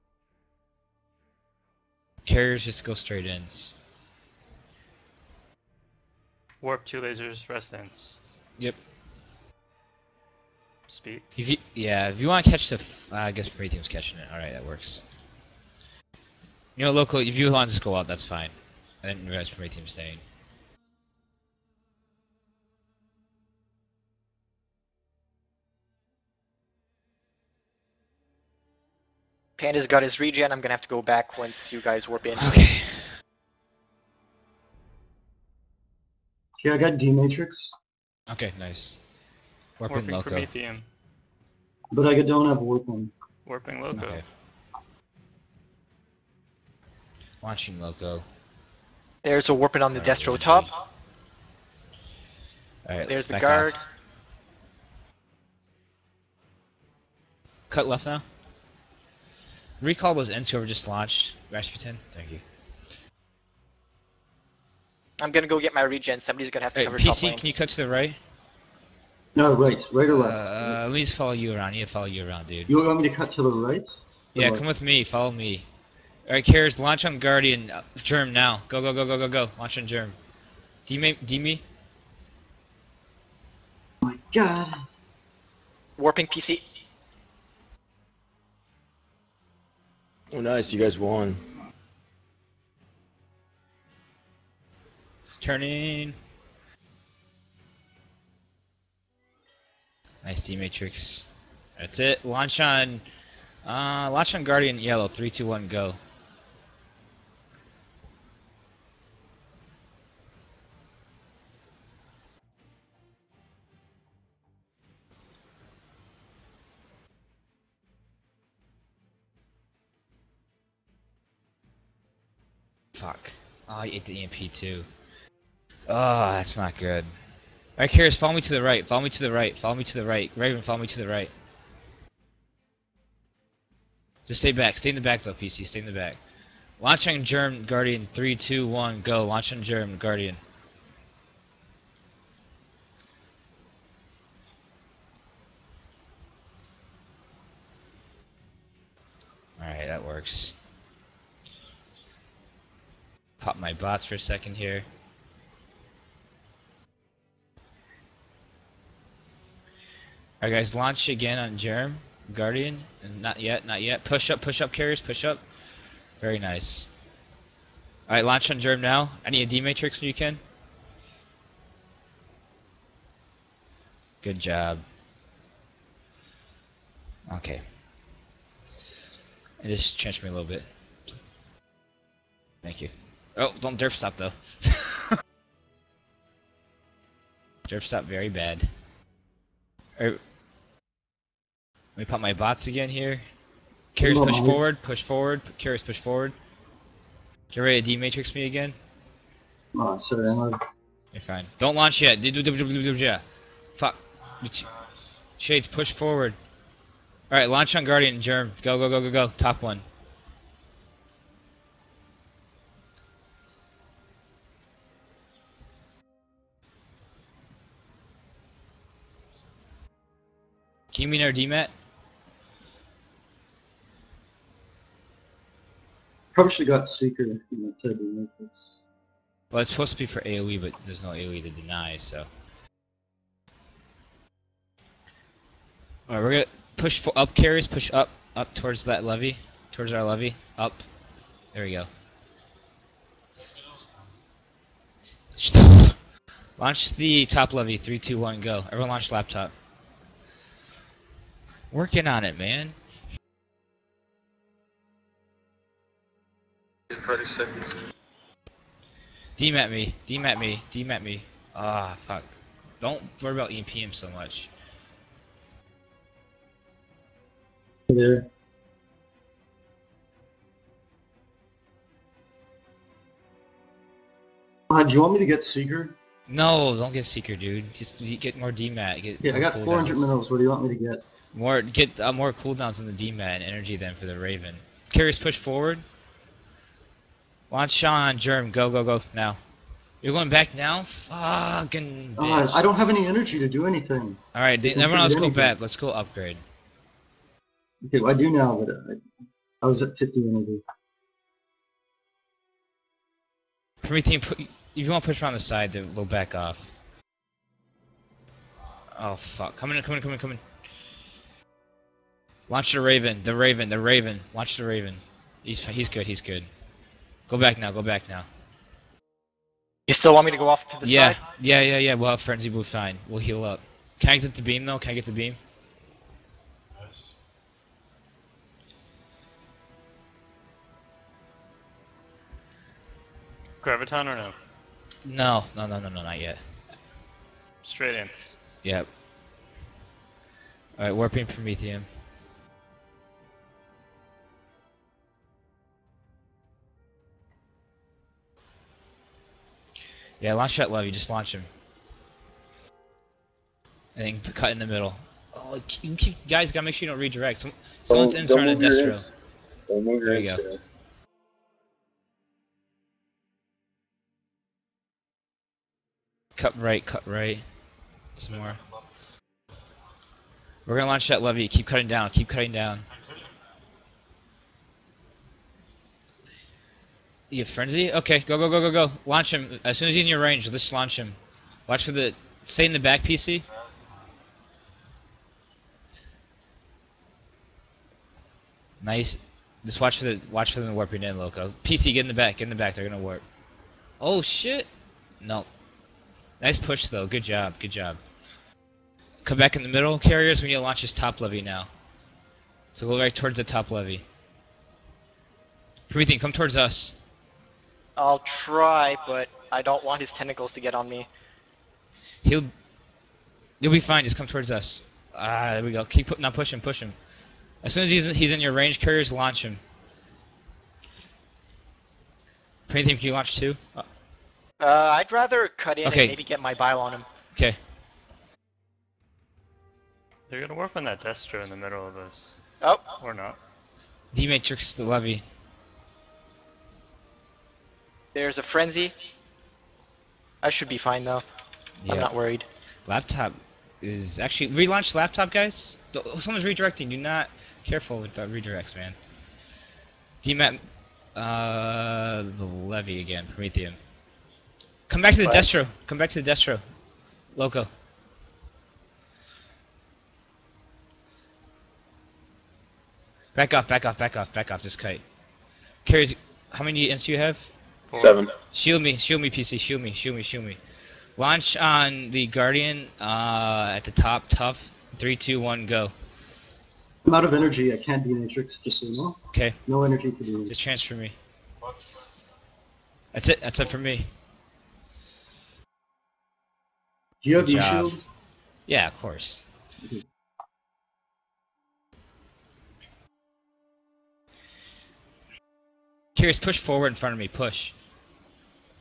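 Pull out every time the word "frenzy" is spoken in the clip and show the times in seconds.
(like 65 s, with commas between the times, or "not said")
322 s, 377 s, 438 s.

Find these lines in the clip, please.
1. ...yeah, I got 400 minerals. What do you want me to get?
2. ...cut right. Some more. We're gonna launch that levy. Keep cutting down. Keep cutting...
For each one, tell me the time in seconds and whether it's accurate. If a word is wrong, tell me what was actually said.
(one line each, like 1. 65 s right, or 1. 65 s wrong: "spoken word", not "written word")
1. 279 s right
2. 366 s right.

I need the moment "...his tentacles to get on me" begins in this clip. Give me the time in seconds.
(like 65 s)
409 s.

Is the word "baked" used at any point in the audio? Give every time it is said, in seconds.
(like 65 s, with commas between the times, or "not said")
not said.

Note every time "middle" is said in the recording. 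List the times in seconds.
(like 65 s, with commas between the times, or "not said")
354 s, 399 s, 431 s.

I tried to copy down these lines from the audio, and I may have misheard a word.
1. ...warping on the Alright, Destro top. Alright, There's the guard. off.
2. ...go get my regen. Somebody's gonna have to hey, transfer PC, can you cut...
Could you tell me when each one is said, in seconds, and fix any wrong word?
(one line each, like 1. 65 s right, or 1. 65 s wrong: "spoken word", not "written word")
1. 49 s right
2. 65 s wrong: "cover", not "transfer".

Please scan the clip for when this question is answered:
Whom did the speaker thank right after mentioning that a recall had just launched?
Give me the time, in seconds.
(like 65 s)
61 s.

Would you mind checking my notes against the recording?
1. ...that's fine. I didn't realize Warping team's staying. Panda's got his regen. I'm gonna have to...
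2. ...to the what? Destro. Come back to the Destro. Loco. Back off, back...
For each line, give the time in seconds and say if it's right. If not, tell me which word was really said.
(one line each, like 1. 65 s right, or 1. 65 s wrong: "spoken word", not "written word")
1. 18 s wrong: "Prey", not "Warping"
2. 455 s right.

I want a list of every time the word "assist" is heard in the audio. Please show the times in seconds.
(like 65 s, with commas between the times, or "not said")
not said.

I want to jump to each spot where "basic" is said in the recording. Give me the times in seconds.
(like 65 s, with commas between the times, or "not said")
not said.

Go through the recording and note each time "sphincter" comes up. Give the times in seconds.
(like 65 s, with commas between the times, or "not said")
not said.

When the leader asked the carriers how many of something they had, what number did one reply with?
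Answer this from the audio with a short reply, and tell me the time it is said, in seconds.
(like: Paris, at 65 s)
7, at 468 s.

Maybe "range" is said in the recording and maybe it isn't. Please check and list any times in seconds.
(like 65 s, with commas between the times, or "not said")
380 s, 418 s.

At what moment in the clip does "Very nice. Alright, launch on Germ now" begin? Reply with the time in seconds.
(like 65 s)
166 s.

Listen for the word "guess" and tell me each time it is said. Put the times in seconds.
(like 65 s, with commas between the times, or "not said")
13 s.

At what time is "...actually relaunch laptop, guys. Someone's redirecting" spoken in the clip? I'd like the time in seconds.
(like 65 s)
444 s.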